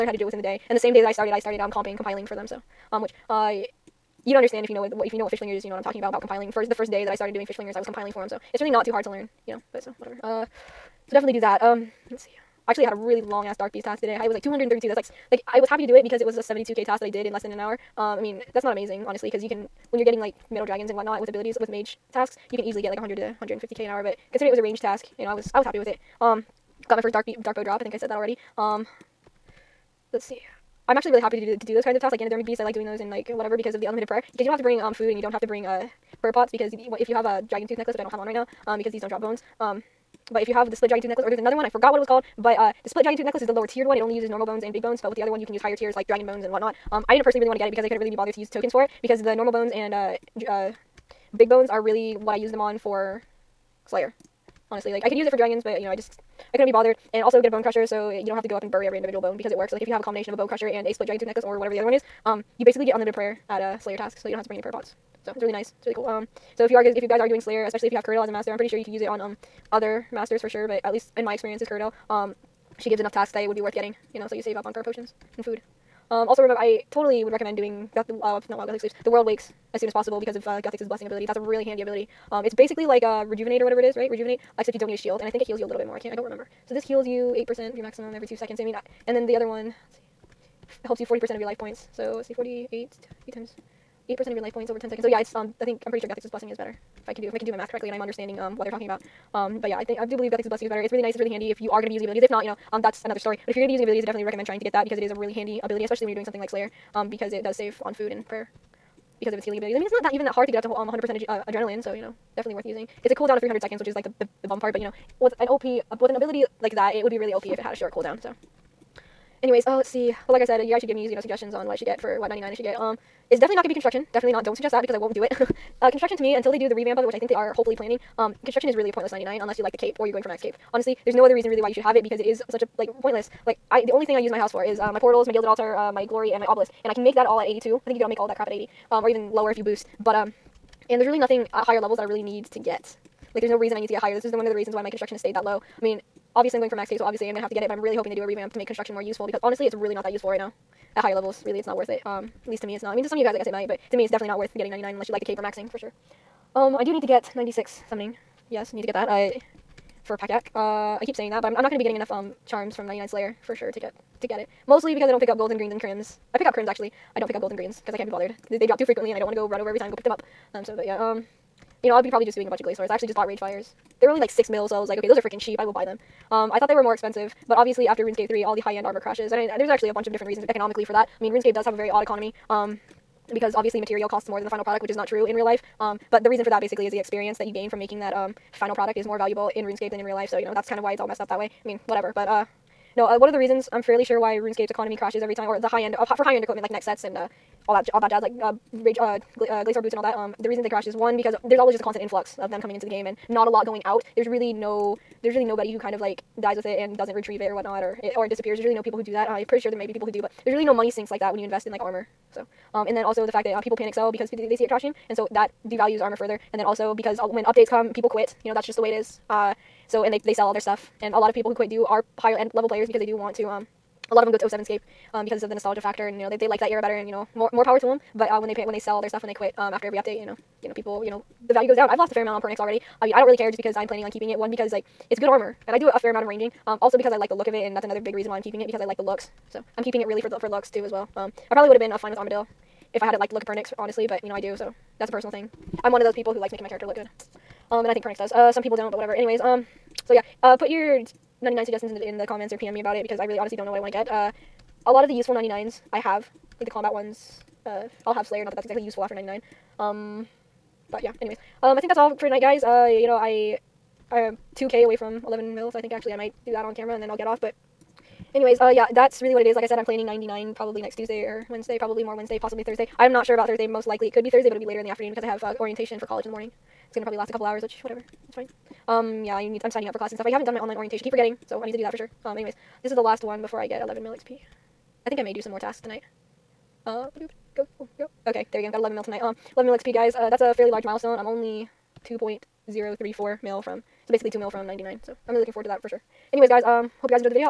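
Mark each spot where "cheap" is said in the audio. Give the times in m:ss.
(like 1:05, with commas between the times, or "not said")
2:55.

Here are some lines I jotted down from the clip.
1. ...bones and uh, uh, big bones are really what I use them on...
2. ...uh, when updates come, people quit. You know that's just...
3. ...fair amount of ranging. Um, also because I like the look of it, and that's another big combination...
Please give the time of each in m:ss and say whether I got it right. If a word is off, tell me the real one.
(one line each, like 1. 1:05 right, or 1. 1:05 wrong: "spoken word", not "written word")
1. 0:49 right
2. 3:37 right
3. 3:55 wrong: "reason", not "combination".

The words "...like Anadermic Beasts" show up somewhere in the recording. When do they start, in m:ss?
0:32.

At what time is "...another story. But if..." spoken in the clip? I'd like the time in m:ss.
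1:43.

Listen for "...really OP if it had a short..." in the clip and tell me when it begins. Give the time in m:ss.
1:57.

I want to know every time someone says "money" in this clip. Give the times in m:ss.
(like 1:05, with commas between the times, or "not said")
3:30.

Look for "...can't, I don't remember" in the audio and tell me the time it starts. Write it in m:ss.
1:25.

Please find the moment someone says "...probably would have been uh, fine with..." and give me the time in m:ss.
4:01.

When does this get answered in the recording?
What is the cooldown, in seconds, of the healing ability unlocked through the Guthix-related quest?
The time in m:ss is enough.
1:53.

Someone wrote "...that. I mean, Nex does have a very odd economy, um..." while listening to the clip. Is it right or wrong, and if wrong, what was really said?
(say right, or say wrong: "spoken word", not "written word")
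wrong: "RuneScape", not "Nex".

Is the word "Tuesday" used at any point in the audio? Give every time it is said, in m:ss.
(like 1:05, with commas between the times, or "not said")
4:30.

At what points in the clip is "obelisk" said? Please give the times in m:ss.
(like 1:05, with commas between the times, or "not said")
2:16.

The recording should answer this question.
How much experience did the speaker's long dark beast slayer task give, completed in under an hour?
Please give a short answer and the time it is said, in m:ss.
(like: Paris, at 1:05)
72k, at 0:16.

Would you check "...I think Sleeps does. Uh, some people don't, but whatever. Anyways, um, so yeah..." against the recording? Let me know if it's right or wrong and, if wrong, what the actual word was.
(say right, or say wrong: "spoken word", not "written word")
wrong: "Pernix", not "Sleeps".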